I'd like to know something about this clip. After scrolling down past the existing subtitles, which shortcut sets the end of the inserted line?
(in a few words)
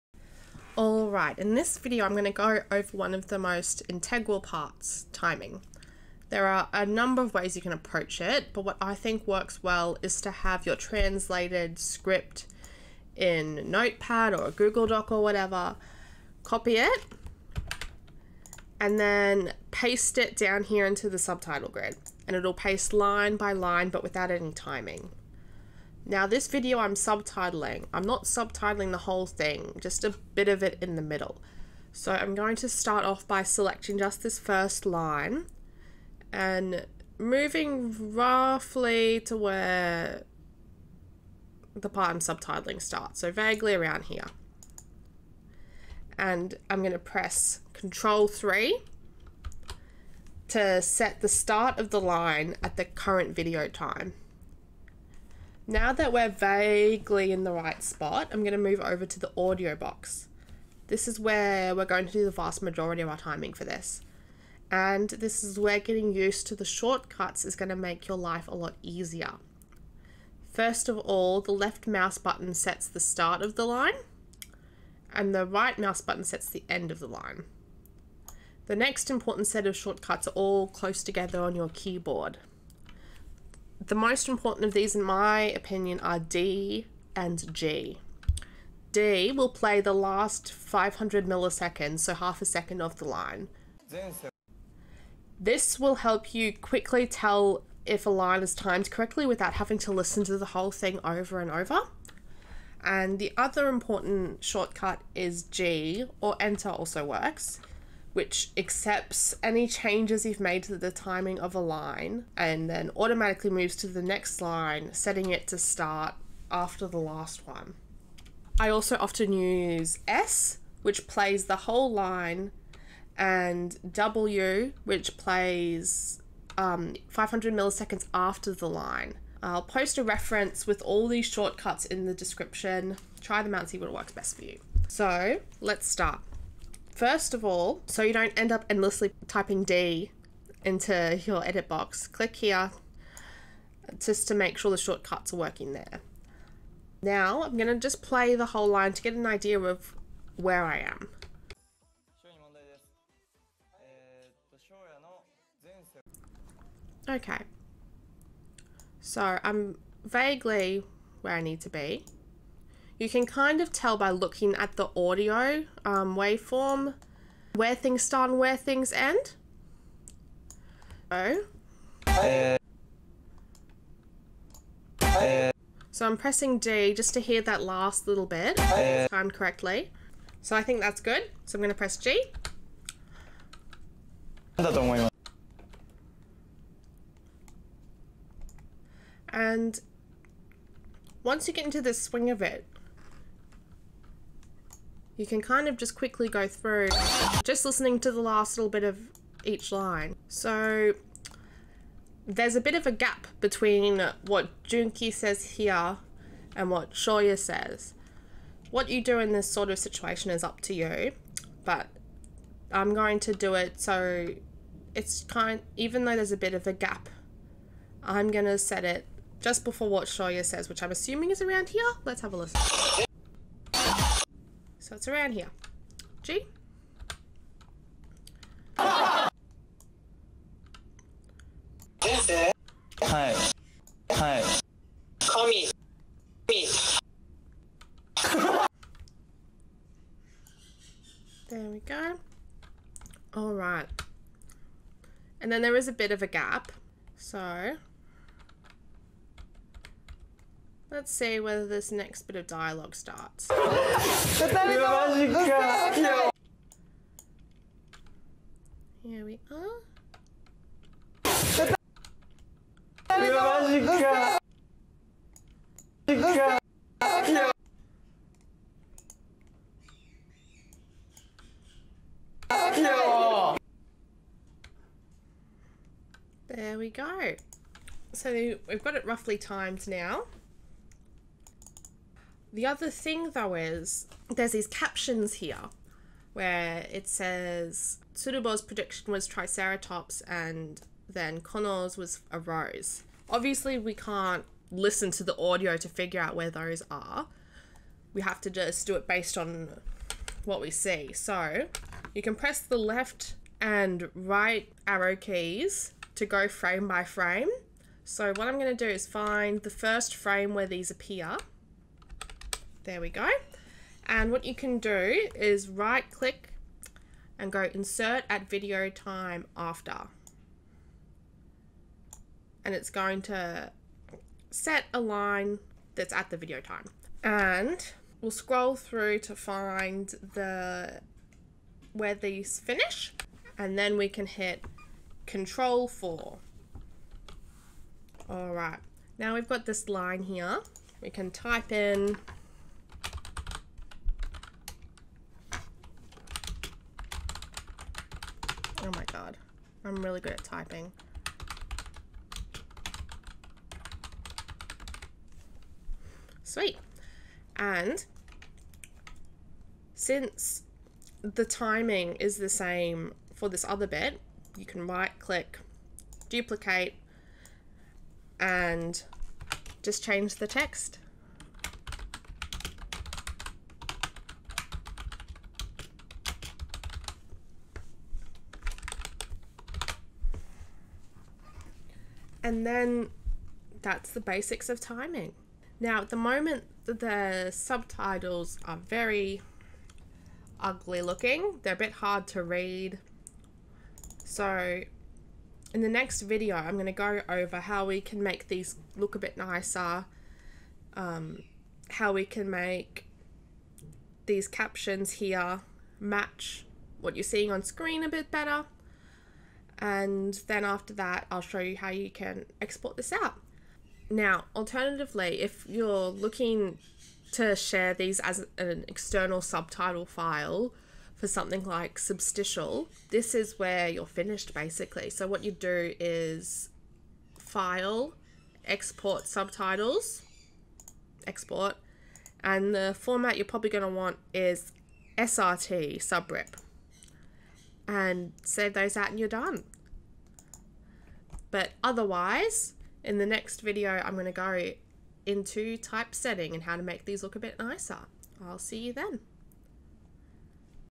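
Control 4.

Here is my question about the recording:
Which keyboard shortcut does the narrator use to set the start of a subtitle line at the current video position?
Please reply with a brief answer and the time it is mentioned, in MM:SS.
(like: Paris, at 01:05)
Control 3, at 00:47.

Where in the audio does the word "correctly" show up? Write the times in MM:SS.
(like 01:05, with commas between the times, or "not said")
01:38, 02:59.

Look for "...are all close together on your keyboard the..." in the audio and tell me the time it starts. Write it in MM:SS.
01:20.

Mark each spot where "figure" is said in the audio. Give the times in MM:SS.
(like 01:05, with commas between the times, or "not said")
04:55.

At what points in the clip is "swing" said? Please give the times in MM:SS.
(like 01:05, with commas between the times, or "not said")
03:11.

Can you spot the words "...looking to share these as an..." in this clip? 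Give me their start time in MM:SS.
06:56.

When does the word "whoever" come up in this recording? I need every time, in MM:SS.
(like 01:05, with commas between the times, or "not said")
not said.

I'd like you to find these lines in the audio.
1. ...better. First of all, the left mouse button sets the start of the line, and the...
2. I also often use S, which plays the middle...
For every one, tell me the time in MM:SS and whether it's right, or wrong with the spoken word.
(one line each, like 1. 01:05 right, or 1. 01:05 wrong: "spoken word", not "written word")
1. 01:08 wrong: "easier", not "better"
2. 01:58 wrong: "whole", not "middle".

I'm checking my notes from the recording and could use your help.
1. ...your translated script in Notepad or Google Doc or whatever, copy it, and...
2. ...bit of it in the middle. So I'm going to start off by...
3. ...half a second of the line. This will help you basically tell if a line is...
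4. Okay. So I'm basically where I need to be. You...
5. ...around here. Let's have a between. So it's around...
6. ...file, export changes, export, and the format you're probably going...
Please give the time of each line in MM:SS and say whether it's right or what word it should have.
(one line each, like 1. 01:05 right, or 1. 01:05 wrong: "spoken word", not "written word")
1. 00:10 right
2. 00:30 right
3. 01:32 wrong: "quickly", not "basically"
4. 02:37 wrong: "vaguely", not "basically"
5. 03:41 wrong: "listen", not "between"
6. 07:07 wrong: "subtitles", not "changes".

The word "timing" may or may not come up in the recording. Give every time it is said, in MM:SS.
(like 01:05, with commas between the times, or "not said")
00:05, 00:24, 01:03, 01:50, 06:01, 06:24.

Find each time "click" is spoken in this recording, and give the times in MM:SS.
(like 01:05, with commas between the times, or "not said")
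02:22, 05:16, 06:05.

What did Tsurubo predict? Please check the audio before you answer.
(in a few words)
Triceratops.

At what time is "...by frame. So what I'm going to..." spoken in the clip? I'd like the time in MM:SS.
05:06.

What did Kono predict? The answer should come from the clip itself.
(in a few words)
a rose.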